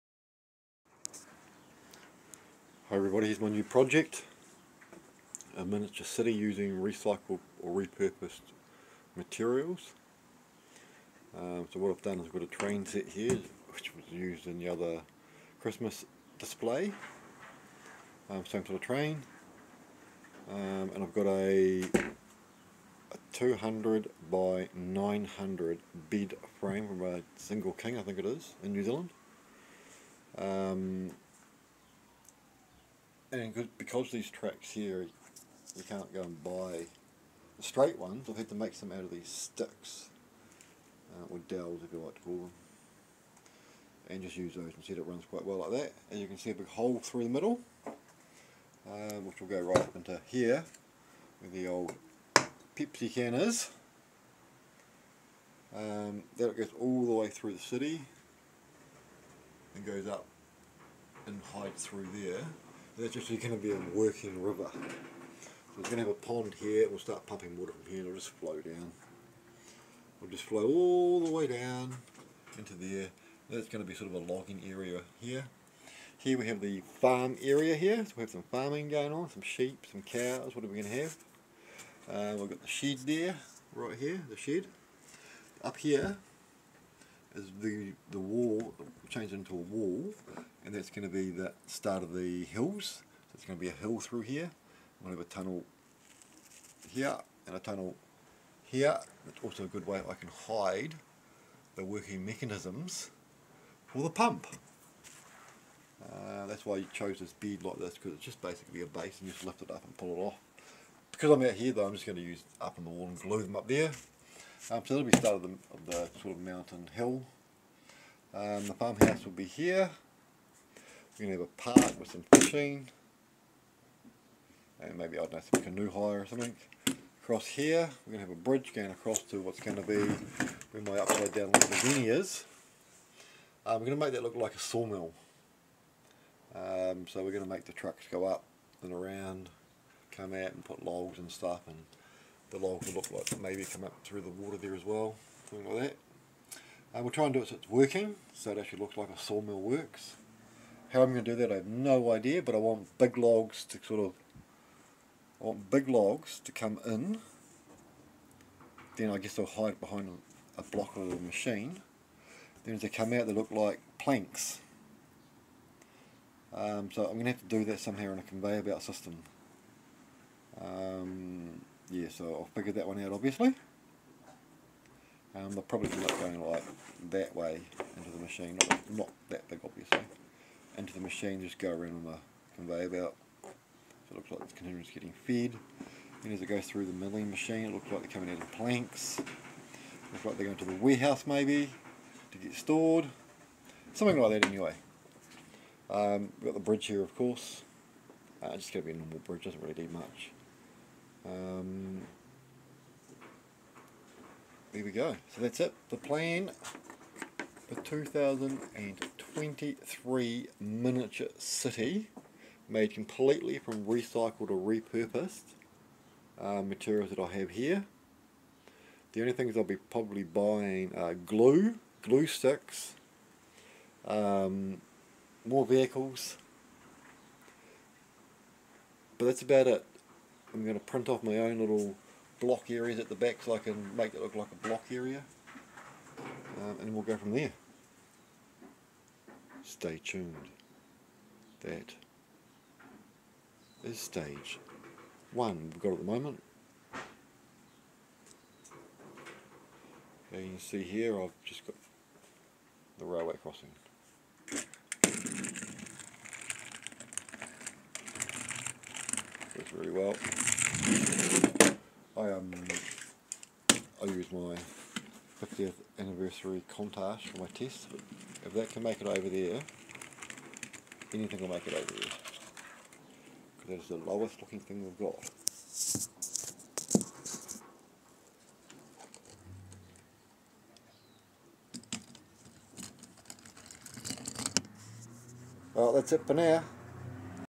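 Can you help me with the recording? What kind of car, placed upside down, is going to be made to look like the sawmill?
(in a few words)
Lamborghini.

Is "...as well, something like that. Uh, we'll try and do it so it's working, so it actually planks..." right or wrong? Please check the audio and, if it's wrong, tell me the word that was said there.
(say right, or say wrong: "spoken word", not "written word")
wrong: "looks", not "planks".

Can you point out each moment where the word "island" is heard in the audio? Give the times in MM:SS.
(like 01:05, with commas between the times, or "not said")
not said.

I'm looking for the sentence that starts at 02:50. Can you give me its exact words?
Um, so I figured that one out obviously.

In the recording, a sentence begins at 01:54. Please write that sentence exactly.
Um, so that'll be the start of the, of the sort of mountain hill.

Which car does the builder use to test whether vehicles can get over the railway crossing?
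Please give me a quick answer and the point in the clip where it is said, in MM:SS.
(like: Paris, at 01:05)
50th anniversary Countach, at 04:25.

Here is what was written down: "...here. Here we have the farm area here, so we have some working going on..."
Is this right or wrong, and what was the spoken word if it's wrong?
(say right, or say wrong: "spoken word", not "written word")
wrong: "farming", not "working".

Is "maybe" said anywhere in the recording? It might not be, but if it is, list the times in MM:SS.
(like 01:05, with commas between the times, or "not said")
02:04, 02:23, 03:11.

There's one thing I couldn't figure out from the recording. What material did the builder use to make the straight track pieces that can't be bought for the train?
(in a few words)
Dowels.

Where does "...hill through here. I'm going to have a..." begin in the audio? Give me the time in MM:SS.
01:33.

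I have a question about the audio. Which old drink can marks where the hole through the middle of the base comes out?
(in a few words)
Pepsi can.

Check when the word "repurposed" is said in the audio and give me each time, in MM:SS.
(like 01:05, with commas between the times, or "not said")
00:07, 03:34.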